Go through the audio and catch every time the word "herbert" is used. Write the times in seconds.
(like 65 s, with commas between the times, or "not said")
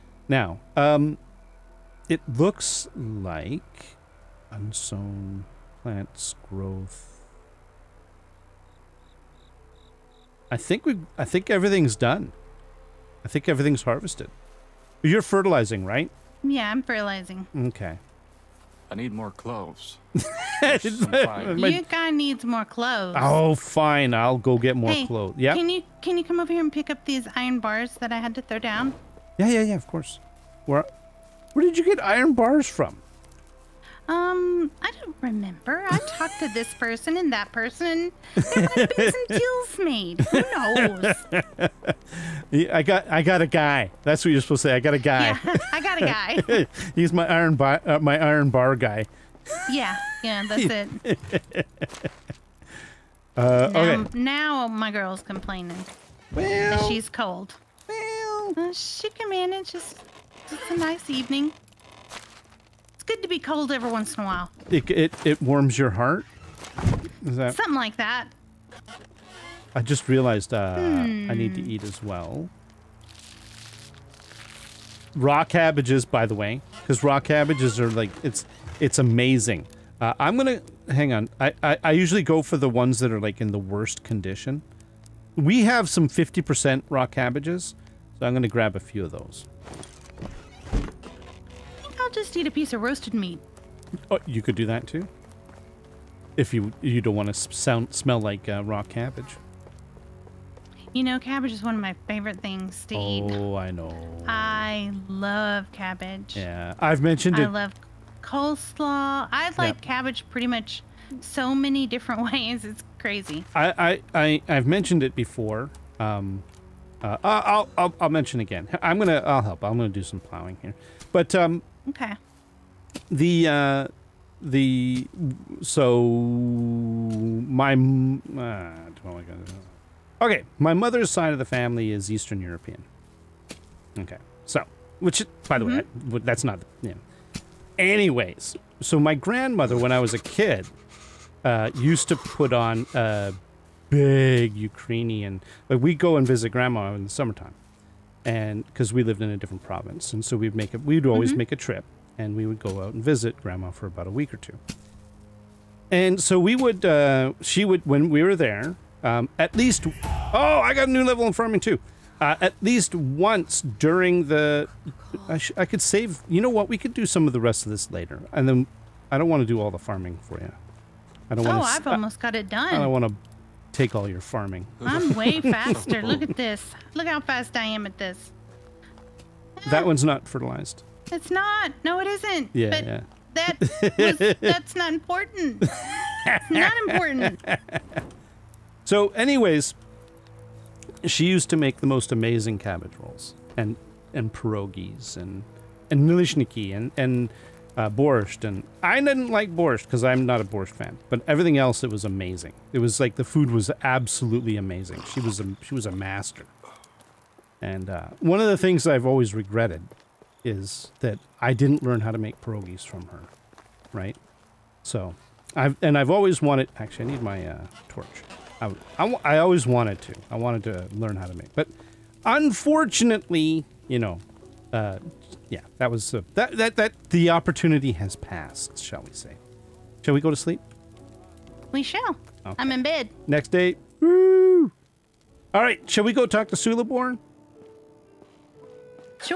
not said.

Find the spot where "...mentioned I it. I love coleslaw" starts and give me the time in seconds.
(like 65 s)
107 s.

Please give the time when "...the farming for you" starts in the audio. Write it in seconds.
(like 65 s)
169 s.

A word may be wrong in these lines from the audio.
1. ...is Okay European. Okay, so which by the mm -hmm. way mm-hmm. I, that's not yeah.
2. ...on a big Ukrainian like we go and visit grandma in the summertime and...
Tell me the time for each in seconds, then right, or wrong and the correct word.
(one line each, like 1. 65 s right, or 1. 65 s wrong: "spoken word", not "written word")
1. 131 s wrong: "Eastern", not "Okay"
2. 142 s right.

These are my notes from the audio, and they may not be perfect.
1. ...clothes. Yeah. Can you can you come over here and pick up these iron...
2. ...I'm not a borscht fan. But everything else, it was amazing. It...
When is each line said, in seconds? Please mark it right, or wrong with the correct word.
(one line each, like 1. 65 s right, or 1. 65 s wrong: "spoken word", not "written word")
1. 25 s right
2. 200 s right.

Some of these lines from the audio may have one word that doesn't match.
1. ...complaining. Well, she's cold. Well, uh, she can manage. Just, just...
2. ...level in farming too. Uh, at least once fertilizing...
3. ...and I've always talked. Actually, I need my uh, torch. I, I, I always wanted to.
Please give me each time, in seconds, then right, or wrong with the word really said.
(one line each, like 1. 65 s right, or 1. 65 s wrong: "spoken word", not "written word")
1. 55 s right
2. 161 s wrong: "during", not "fertilizing"
3. 215 s wrong: "wanted", not "talked".